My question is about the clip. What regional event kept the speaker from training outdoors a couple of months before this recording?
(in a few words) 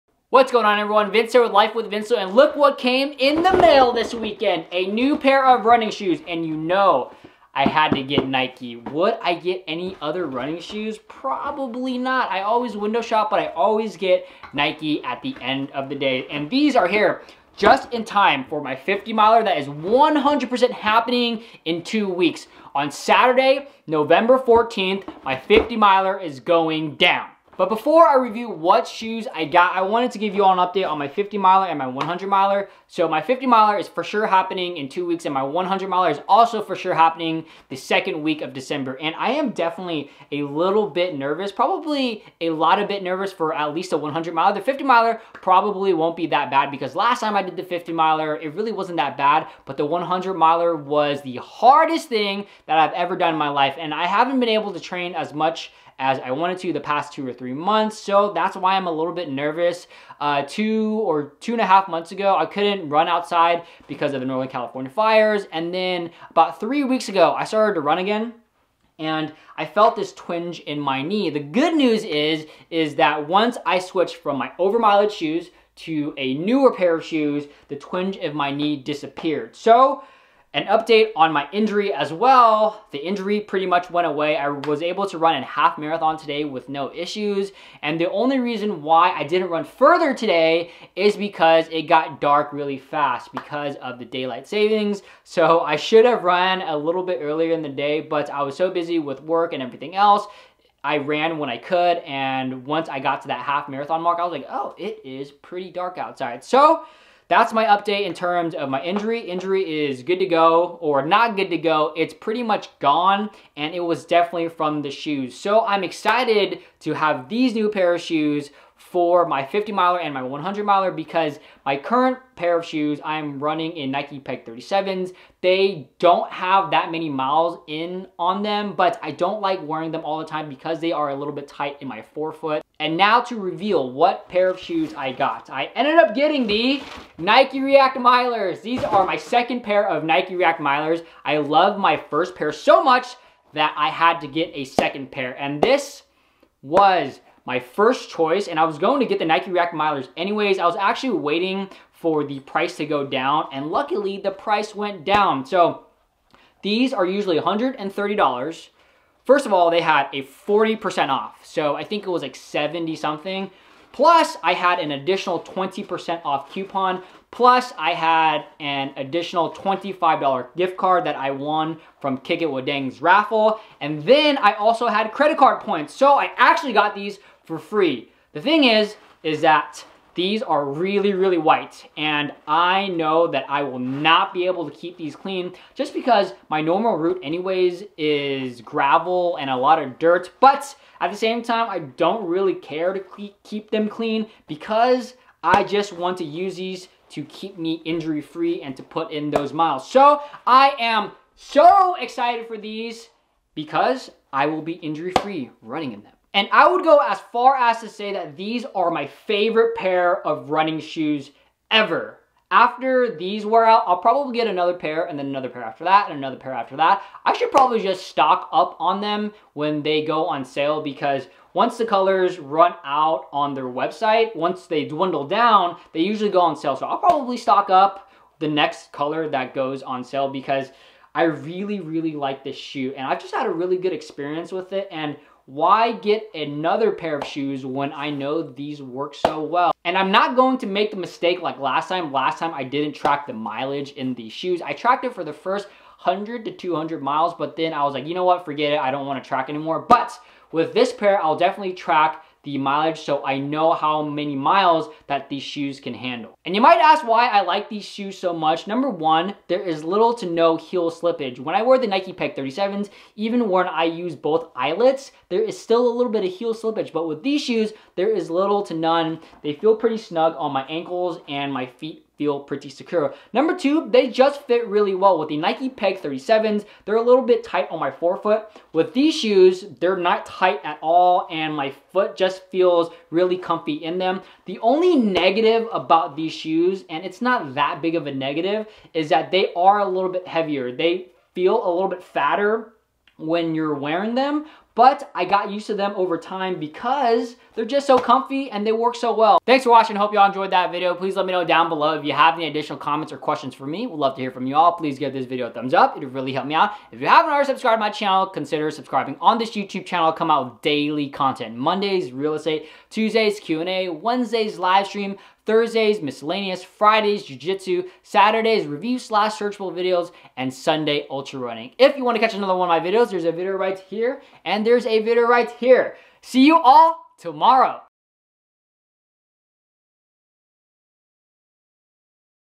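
Northern California fires.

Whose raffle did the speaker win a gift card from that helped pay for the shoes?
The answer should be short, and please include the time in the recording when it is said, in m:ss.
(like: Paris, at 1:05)
Kick It With Dang, at 2:52.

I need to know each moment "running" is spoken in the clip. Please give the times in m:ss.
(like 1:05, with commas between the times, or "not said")
0:05, 0:10, 2:03, 3:25, 3:30, 5:21.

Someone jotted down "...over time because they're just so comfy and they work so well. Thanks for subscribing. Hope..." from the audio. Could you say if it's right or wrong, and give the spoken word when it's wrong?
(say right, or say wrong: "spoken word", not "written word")
wrong: "watching", not "subscribing".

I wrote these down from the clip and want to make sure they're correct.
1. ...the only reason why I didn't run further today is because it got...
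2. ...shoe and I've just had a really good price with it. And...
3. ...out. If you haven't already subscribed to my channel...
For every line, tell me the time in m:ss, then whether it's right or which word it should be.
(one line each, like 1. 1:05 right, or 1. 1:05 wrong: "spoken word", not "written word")
1. 1:27 right
2. 3:52 wrong: "experience", not "price"
3. 5:06 right.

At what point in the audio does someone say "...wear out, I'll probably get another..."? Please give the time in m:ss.
3:33.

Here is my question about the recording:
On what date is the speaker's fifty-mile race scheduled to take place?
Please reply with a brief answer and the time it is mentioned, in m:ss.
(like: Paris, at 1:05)
November 14th, at 0:23.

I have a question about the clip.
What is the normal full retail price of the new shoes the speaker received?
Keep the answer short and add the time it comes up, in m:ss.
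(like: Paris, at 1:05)
$130, at 2:37.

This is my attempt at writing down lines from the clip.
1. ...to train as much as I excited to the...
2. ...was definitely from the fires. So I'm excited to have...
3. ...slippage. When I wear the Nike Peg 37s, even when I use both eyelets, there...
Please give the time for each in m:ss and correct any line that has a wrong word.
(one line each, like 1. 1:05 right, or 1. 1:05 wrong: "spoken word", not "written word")
1. 0:54 wrong: "wanted", not "excited"
2. 1:53 wrong: "shoes", not "fires"
3. 4:20 right.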